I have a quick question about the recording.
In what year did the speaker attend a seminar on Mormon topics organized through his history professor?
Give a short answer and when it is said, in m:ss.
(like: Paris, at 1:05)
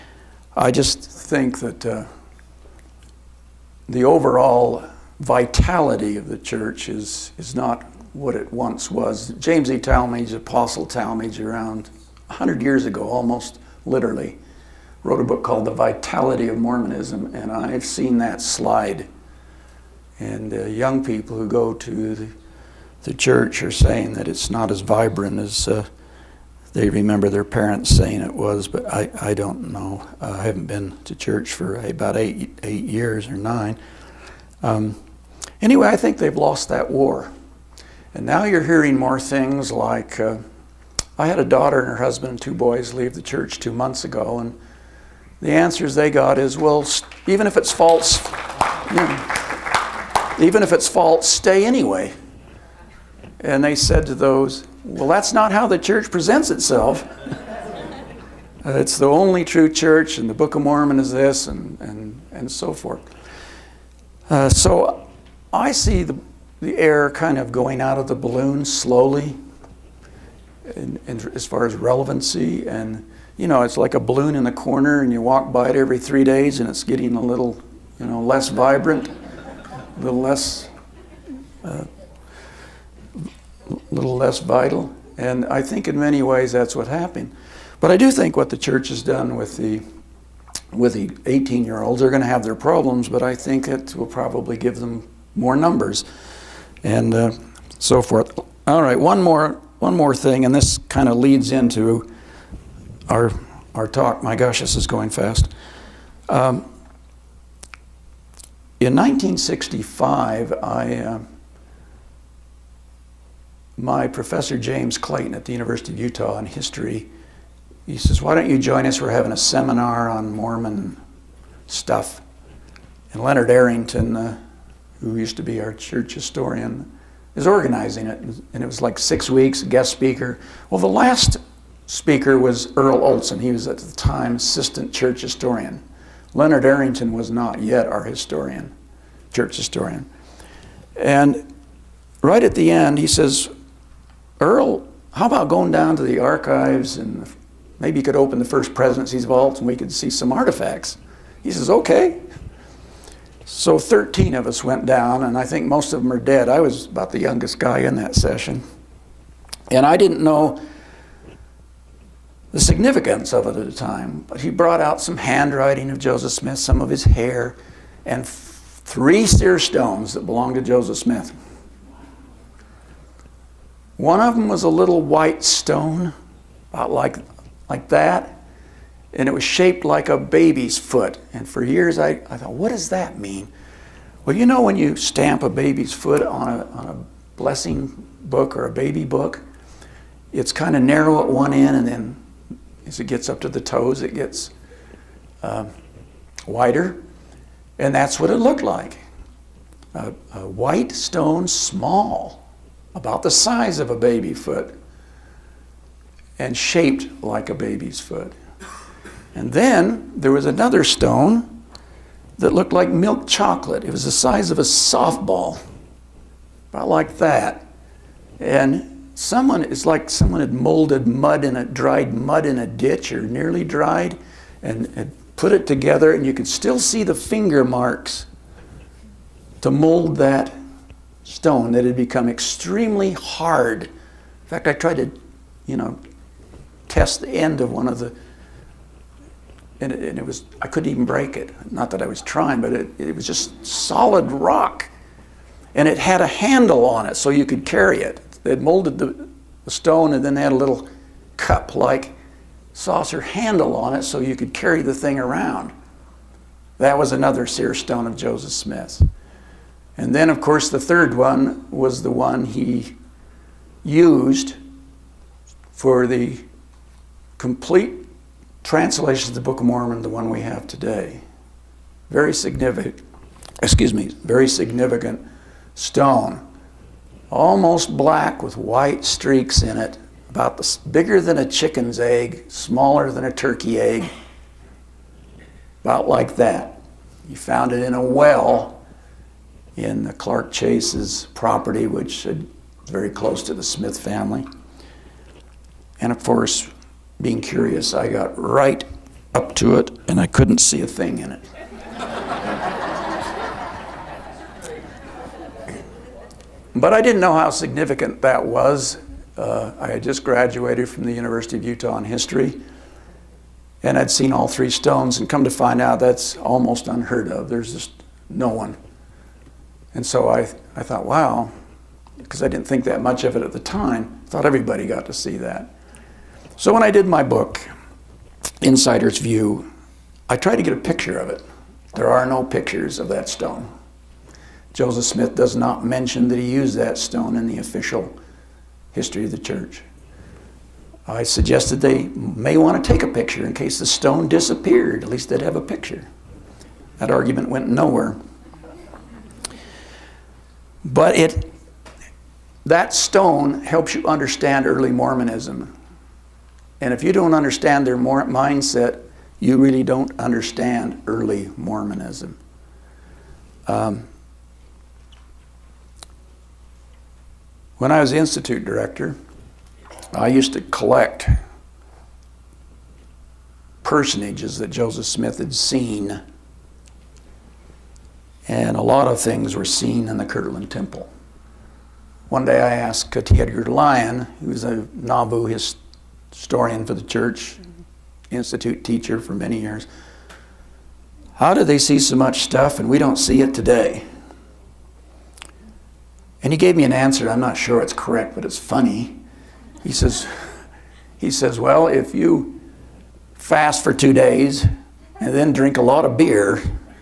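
1965, at 1:48.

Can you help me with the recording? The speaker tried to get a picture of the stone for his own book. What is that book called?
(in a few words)
Insider's View.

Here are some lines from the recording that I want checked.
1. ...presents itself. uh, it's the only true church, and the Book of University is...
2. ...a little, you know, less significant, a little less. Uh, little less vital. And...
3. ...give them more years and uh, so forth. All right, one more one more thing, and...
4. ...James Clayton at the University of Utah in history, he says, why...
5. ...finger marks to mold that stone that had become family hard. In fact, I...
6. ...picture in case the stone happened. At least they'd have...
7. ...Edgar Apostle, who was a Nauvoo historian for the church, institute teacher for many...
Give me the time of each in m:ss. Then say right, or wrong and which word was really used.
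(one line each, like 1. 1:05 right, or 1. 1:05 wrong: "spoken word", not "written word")
1. 0:56 wrong: "Mormon", not "University"
2. 1:17 wrong: "vibrant", not "significant"
3. 1:34 wrong: "numbers", not "years"
4. 1:54 right
5. 3:47 wrong: "extremely", not "family"
6. 5:43 wrong: "disappeared", not "happened"
7. 6:23 wrong: "Lyon", not "Apostle".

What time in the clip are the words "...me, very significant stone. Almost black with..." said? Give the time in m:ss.
4:33.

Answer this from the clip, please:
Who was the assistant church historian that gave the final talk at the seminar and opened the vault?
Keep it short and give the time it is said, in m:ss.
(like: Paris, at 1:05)
Earl Olson, at 2:12.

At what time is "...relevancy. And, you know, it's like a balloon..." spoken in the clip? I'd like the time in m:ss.
1:11.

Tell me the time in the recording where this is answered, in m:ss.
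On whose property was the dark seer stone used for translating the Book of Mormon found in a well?
4:50.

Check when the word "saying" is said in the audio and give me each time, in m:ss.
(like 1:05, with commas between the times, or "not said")
0:23, 0:27.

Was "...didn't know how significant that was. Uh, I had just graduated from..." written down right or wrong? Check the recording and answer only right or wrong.
right.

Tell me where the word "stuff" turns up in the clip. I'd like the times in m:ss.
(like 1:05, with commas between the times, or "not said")
2:01, 6:32.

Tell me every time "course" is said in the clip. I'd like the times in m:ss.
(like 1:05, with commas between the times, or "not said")
4:20, 4:56.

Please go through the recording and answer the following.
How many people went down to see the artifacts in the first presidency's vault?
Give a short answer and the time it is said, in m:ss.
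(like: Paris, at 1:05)
13, at 2:33.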